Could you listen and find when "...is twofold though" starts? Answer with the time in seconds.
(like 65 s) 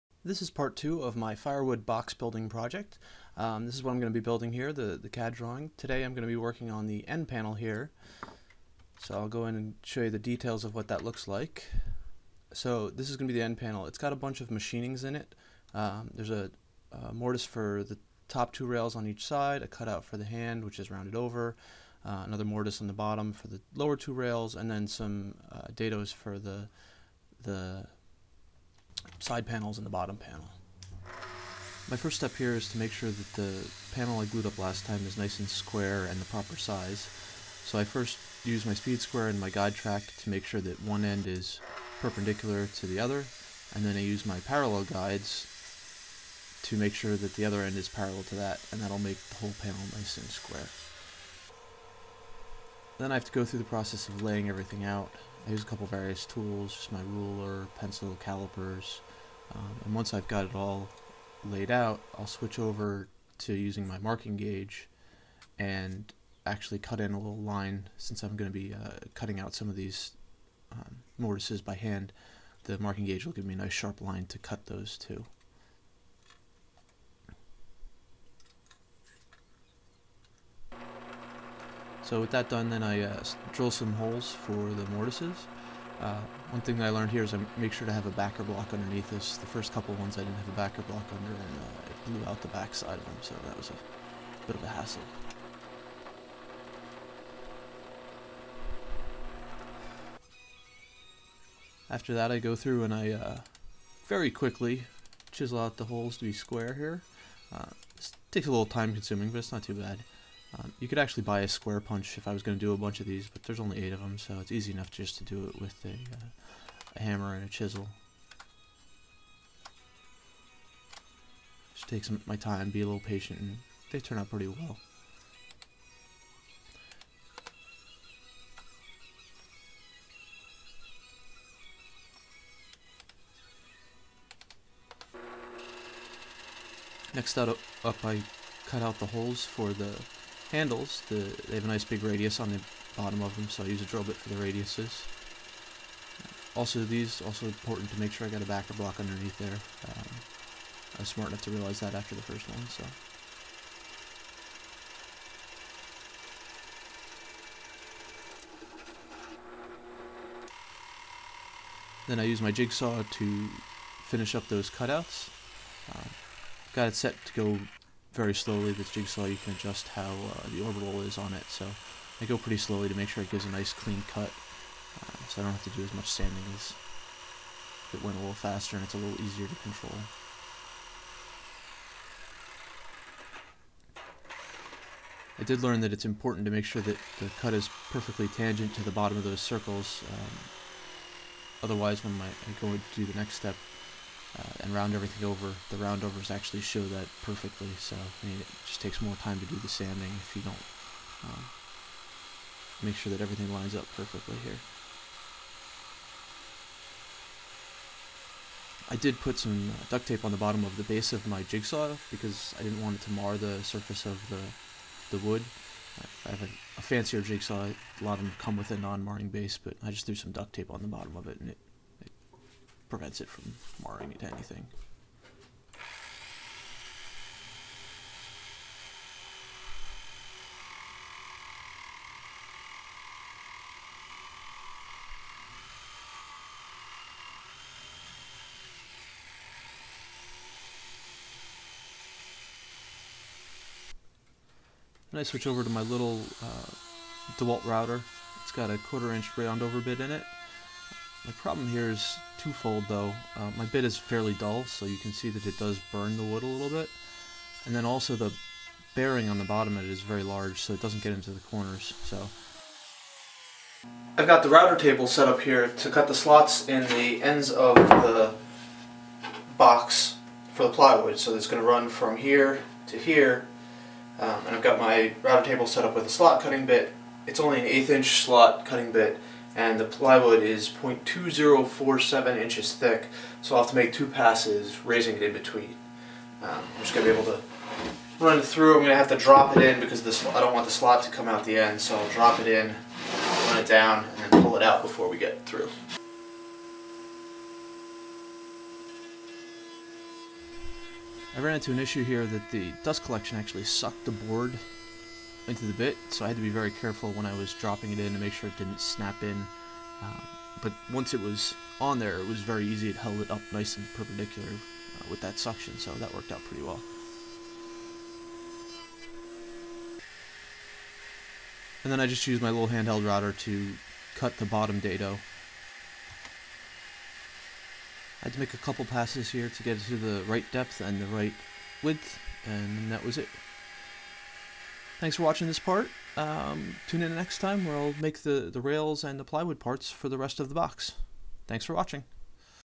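251 s.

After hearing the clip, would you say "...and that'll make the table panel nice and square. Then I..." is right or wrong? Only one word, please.
wrong.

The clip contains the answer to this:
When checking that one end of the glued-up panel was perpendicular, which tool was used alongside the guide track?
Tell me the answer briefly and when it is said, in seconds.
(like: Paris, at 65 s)
speed square, at 38 s.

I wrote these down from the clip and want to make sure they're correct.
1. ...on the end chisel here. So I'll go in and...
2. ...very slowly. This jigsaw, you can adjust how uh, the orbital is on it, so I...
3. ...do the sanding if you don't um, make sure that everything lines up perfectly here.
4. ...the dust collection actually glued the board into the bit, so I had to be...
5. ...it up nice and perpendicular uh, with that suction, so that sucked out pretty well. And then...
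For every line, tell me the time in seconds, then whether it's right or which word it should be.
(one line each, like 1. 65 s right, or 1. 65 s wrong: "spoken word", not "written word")
1. 6 s wrong: "panel", not "chisel"
2. 168 s right
3. 199 s right
4. 302 s wrong: "sucked", not "glued"
5. 313 s wrong: "worked", not "sucked".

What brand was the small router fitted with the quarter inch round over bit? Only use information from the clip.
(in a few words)
DeWalt.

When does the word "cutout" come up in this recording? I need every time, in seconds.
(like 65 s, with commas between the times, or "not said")
19 s, 164 s.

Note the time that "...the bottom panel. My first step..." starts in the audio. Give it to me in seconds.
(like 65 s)
29 s.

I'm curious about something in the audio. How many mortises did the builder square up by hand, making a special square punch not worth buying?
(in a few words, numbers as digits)
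8.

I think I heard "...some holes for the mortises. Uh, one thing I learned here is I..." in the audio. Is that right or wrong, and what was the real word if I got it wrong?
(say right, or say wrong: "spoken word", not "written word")
right.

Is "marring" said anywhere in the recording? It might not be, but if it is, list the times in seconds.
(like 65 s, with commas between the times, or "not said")
218 s, 223 s.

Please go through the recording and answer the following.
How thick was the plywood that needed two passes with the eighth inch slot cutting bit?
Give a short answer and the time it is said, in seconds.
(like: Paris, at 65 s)
0.2047 inches, at 280 s.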